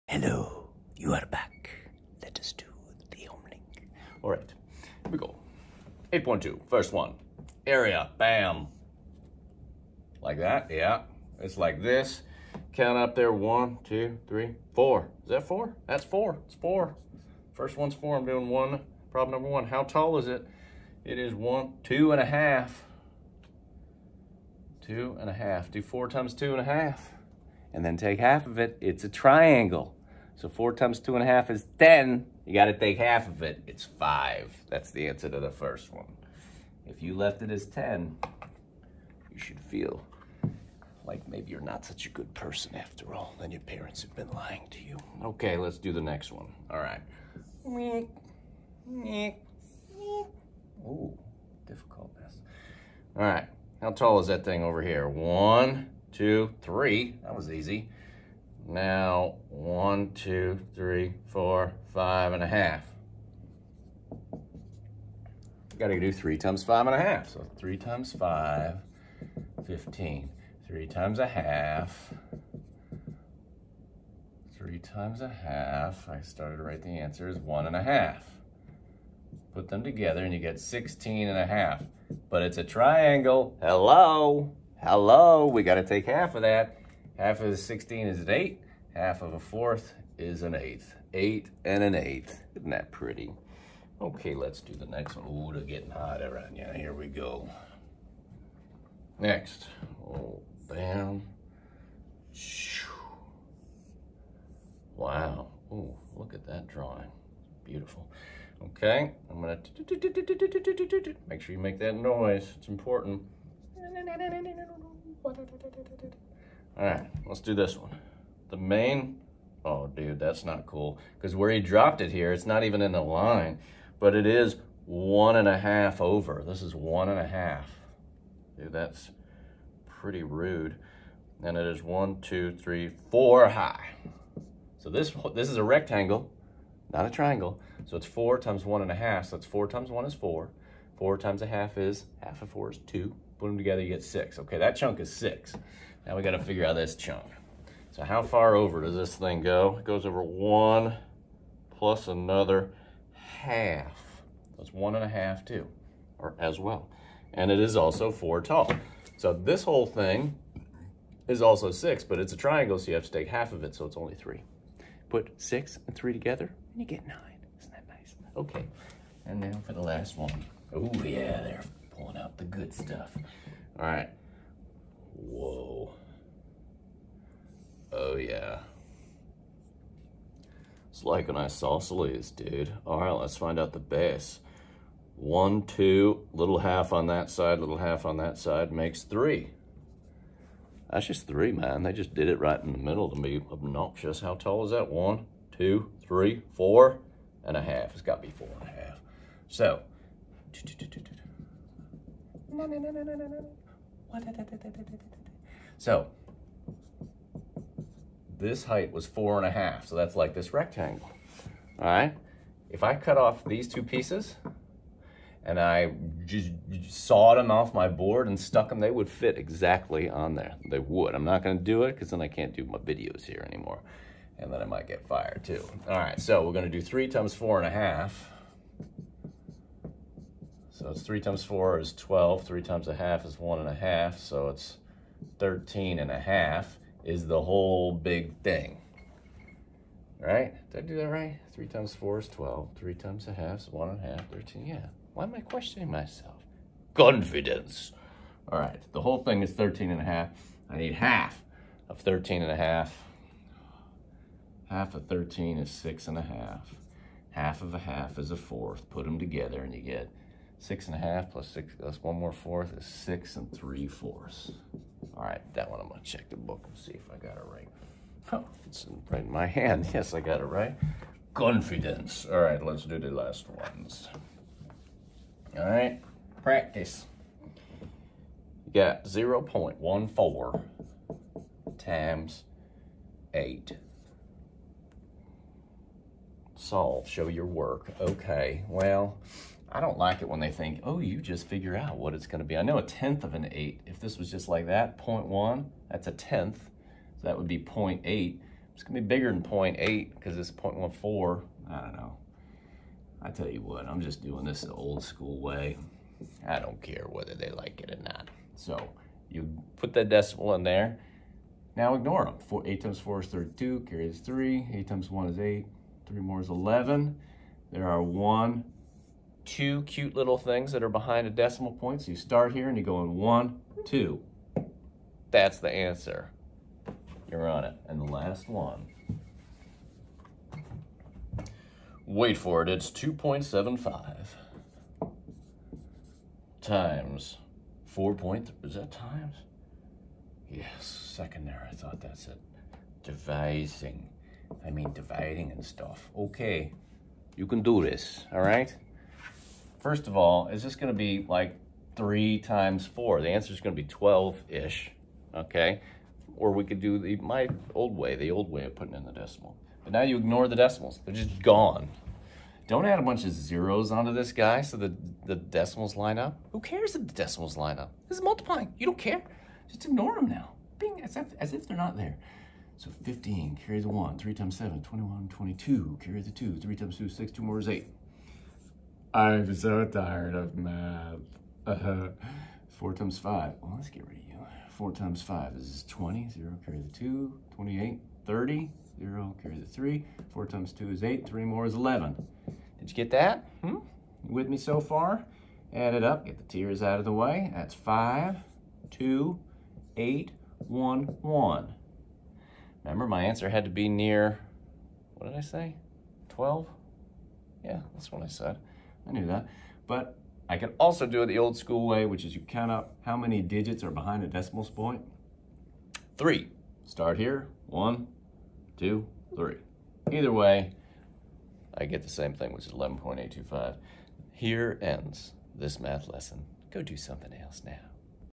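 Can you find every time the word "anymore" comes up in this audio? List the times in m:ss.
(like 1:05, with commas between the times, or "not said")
3:43.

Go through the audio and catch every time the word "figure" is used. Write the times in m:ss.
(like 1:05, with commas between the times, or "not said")
2:26, 4:51.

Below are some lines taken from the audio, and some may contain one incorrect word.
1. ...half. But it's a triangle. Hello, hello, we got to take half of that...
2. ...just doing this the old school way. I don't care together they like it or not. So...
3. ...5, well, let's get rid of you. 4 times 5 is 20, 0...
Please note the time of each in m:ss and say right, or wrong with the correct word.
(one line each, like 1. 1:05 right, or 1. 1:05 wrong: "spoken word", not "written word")
1. 1:21 right
2. 5:04 wrong: "whether", not "together"
3. 6:23 right.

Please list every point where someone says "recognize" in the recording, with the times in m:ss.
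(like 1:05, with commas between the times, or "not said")
not said.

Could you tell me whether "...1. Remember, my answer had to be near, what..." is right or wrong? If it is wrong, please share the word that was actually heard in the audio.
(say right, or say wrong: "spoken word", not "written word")
right.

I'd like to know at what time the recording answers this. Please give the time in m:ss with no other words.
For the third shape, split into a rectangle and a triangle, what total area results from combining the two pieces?
2:47.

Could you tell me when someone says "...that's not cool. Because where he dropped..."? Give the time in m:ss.
2:00.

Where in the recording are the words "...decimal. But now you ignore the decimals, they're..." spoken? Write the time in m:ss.
5:59.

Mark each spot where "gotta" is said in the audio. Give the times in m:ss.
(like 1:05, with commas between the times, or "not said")
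0:32, 2:26.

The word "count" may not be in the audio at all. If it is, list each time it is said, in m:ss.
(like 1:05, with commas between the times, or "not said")
0:12, 6:52.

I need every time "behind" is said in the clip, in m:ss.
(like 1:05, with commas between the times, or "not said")
5:20, 6:53.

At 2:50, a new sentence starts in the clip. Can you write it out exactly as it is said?
Oh yeah, they're pulling out the good stuff.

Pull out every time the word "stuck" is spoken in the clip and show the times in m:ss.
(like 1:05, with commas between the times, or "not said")
3:38.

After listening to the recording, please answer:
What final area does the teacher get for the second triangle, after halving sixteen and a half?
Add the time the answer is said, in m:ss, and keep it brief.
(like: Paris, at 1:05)
8 and 1/8, at 1:31.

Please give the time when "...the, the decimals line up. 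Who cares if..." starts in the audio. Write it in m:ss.
6:04.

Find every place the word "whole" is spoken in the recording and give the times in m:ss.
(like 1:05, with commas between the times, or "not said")
2:39, 3:57, 4:09.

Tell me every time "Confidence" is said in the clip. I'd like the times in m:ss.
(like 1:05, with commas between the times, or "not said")
4:06, 4:31.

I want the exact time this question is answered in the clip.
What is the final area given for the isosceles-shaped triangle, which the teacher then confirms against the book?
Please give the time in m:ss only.
4:22.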